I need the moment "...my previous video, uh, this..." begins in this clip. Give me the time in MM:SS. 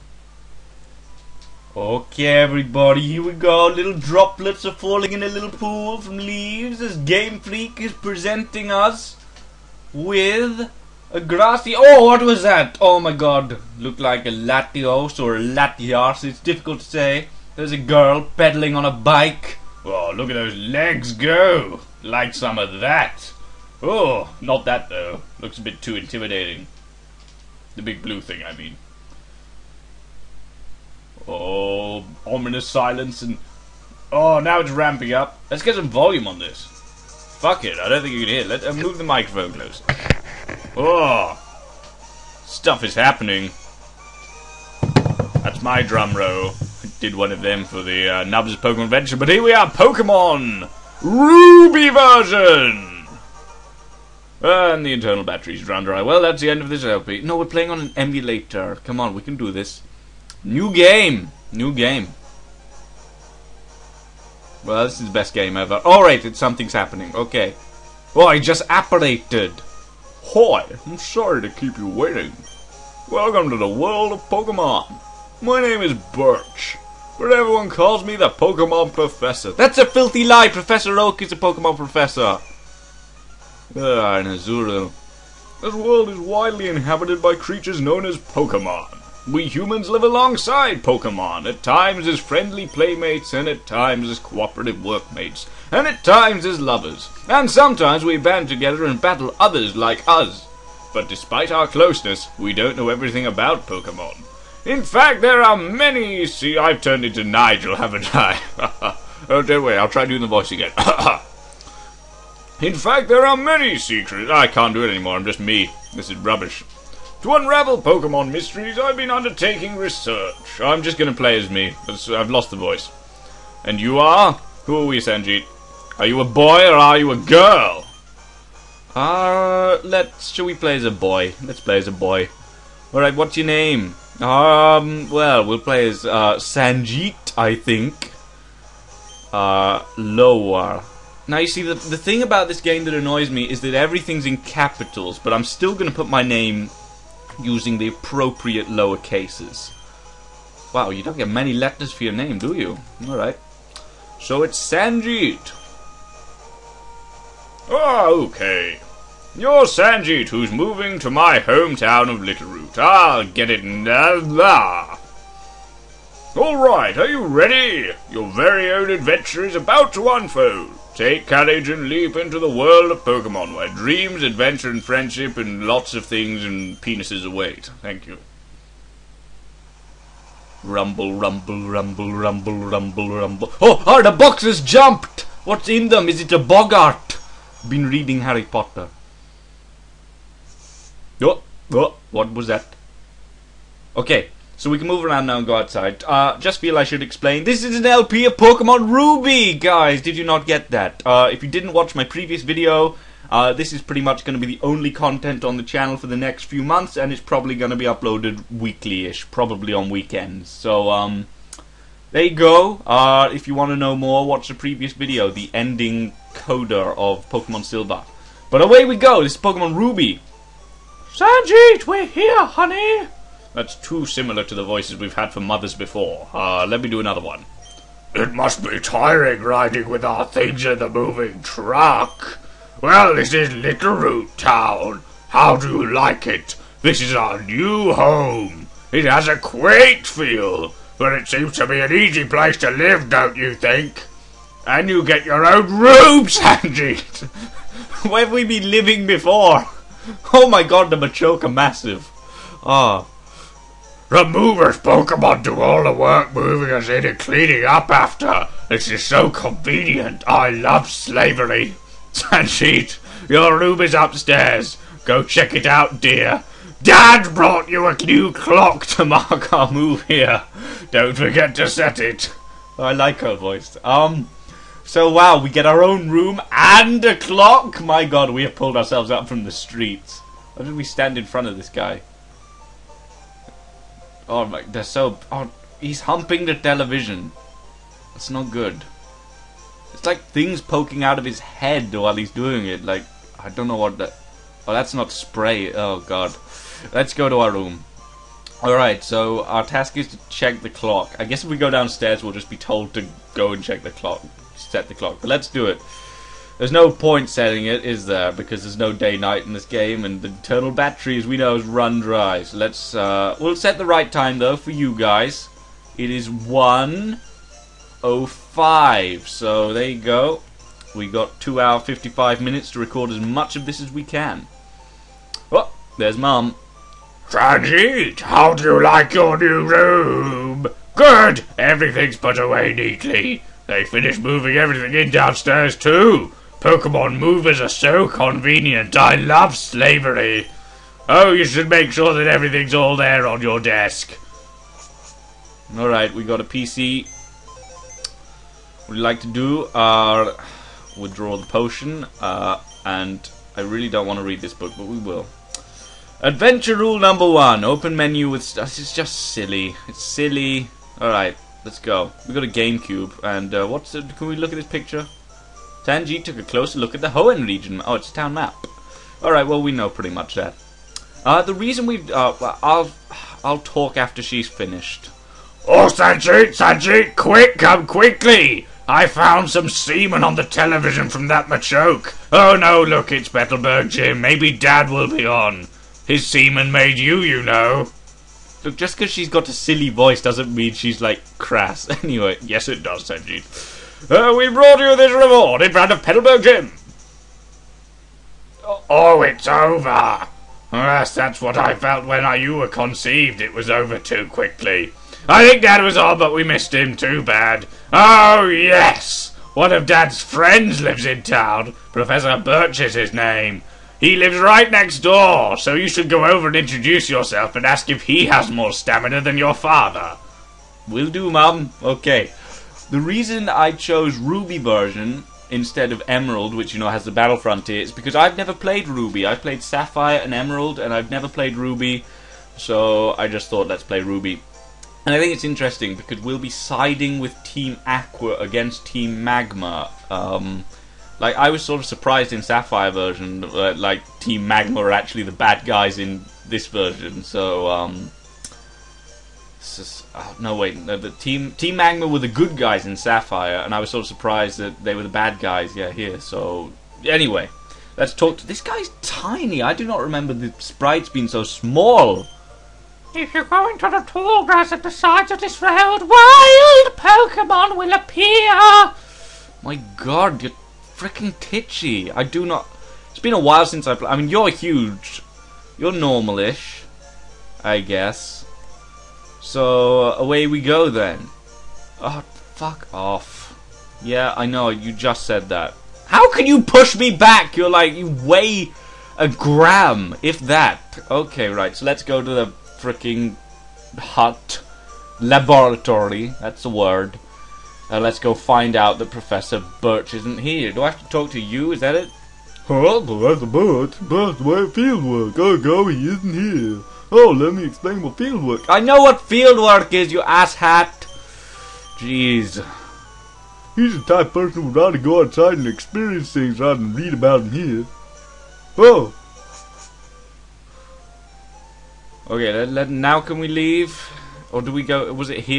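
03:21.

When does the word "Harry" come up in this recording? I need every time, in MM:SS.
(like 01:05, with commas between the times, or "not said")
03:08.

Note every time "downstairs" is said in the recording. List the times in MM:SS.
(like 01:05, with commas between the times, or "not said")
05:01, 05:35.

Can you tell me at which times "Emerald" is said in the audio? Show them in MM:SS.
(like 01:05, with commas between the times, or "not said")
07:06, 07:10.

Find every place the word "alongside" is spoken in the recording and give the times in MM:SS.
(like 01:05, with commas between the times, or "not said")
01:30.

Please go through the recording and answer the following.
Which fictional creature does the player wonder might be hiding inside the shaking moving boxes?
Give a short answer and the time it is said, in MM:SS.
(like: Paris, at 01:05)
Boggart, at 03:06.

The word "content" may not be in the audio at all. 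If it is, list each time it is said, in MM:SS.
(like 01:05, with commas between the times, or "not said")
03:24.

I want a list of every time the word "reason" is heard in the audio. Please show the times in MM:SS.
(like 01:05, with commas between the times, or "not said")
06:11, 07:03.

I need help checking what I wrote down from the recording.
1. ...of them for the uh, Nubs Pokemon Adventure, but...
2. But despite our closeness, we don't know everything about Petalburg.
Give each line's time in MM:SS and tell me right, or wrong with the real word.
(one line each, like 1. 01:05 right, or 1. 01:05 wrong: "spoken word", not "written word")
1. 00:47 right
2. 01:40 wrong: "Pokemon", not "Petalburg".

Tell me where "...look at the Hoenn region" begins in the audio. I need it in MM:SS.
06:06.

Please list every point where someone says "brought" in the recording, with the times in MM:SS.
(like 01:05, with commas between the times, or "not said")
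04:27, 06:34.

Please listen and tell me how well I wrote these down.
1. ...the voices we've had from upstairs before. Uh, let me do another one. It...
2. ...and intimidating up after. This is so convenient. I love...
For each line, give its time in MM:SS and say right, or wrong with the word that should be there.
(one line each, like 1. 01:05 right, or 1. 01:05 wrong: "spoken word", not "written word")
1. 03:44 wrong: "mothers", not "upstairs"
2. 04:17 wrong: "cleaning", not "intimidating".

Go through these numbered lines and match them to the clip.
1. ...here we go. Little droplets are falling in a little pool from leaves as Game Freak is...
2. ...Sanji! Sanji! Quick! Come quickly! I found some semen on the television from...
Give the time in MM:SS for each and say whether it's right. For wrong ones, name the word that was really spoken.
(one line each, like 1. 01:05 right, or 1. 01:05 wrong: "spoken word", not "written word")
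1. 00:03 right
2. 06:15 right.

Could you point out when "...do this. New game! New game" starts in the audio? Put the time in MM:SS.
00:59.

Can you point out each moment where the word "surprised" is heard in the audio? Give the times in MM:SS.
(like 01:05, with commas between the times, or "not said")
07:21, 07:34.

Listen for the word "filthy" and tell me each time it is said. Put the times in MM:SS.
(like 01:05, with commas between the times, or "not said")
01:19.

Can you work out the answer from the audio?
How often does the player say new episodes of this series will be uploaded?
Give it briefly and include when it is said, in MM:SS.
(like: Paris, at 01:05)
Weekly-ish, at 03:28.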